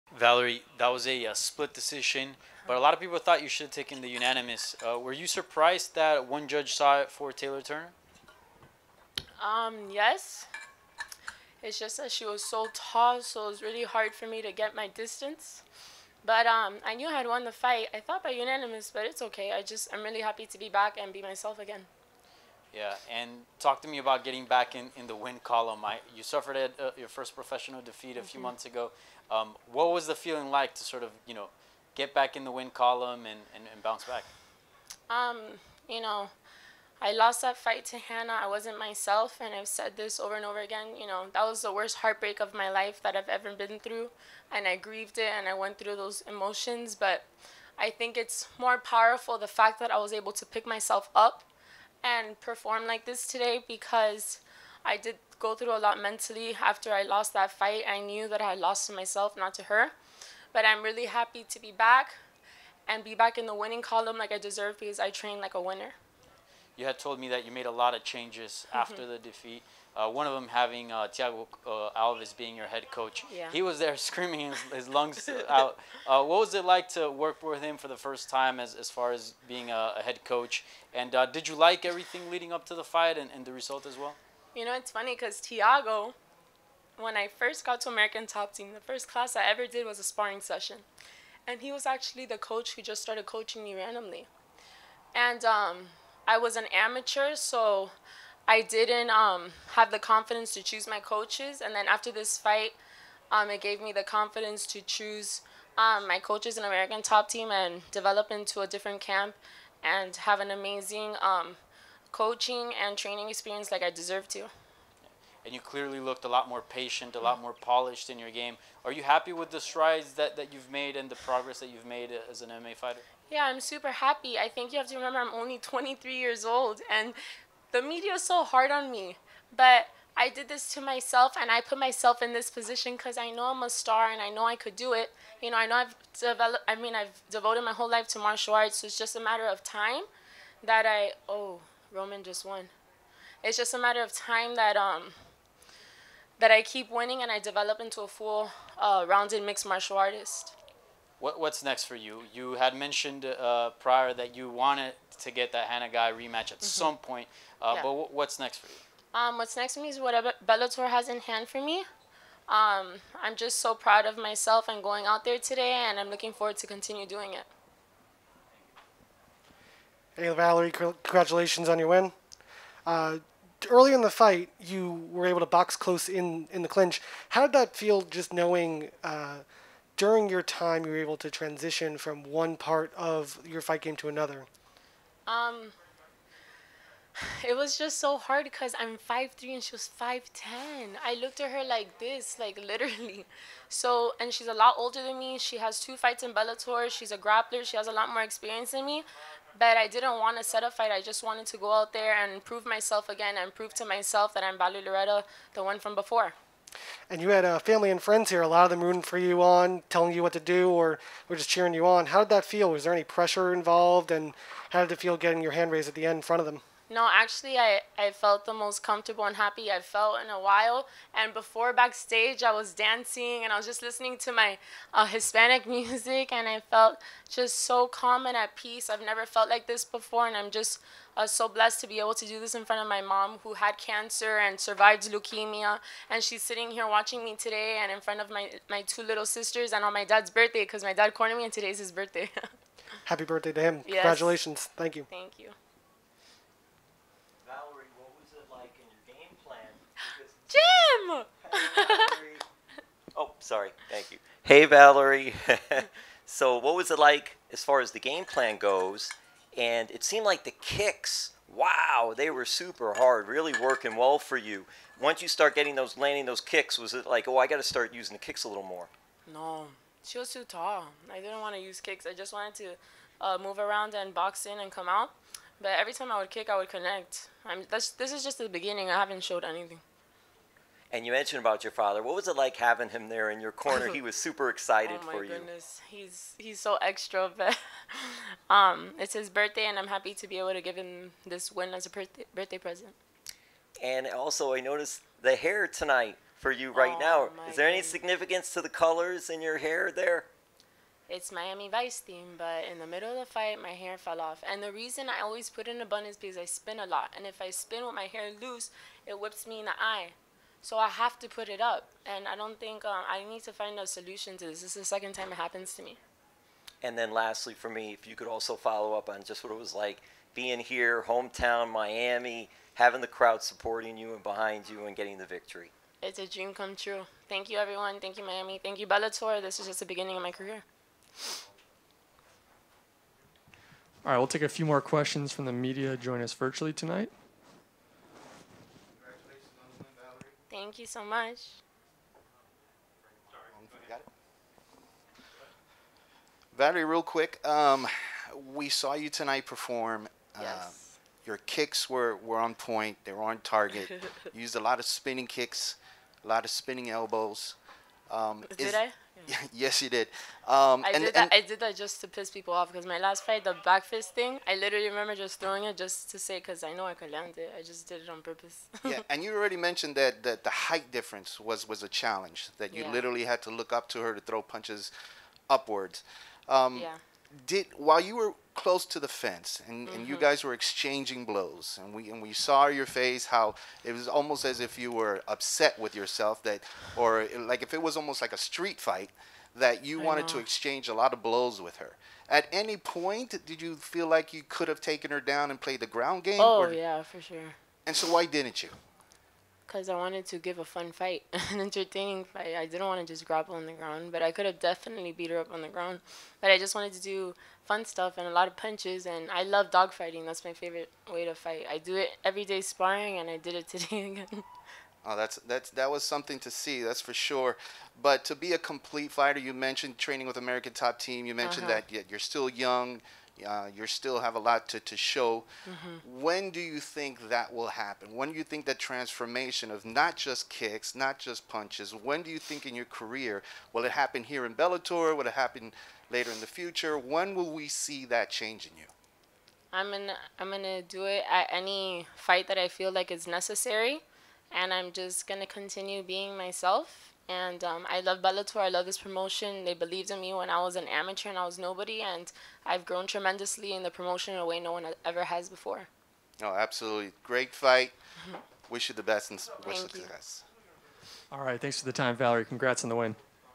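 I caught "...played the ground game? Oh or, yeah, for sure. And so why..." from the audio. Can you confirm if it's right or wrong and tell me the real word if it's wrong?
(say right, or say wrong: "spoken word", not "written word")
right.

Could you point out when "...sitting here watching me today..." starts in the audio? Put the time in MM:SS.
03:56.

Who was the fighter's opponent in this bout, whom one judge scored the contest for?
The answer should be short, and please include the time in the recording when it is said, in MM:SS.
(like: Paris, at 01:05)
Taylor Turner, at 00:07.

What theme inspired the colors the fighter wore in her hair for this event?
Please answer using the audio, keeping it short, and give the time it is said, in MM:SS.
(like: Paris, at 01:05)
Miami Vice, at 05:01.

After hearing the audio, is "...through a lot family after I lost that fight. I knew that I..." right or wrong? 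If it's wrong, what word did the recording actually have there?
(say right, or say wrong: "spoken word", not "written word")
wrong: "mentally", not "family".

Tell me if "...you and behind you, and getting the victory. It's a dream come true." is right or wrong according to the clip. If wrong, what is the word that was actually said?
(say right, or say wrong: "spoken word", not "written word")
right.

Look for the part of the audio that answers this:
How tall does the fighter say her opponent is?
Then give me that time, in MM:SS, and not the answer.
03:09.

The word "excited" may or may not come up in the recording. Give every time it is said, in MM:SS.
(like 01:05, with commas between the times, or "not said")
04:44.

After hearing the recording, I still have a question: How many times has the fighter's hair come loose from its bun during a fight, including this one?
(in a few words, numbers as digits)
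2.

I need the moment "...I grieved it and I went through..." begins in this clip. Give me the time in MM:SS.
00:44.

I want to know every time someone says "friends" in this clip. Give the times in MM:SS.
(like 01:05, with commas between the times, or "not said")
03:28.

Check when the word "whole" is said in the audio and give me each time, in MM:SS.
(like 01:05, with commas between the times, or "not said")
02:17.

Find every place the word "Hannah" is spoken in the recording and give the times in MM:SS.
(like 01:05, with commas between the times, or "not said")
00:37, 02:35.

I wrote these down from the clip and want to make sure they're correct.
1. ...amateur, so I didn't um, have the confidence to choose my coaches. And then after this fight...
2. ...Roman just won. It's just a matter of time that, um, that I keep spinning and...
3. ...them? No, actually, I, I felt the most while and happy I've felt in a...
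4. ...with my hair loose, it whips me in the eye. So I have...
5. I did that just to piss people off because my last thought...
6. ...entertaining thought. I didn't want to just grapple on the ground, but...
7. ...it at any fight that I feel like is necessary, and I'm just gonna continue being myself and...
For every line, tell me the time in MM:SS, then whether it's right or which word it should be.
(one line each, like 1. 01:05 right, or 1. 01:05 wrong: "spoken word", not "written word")
1. 01:36 right
2. 02:21 wrong: "winning", not "spinning"
3. 03:36 wrong: "comfortable", not "while"
4. 05:07 right
5. 06:01 wrong: "fight", not "thought"
6. 06:41 wrong: "fight", not "thought"
7. 07:21 right.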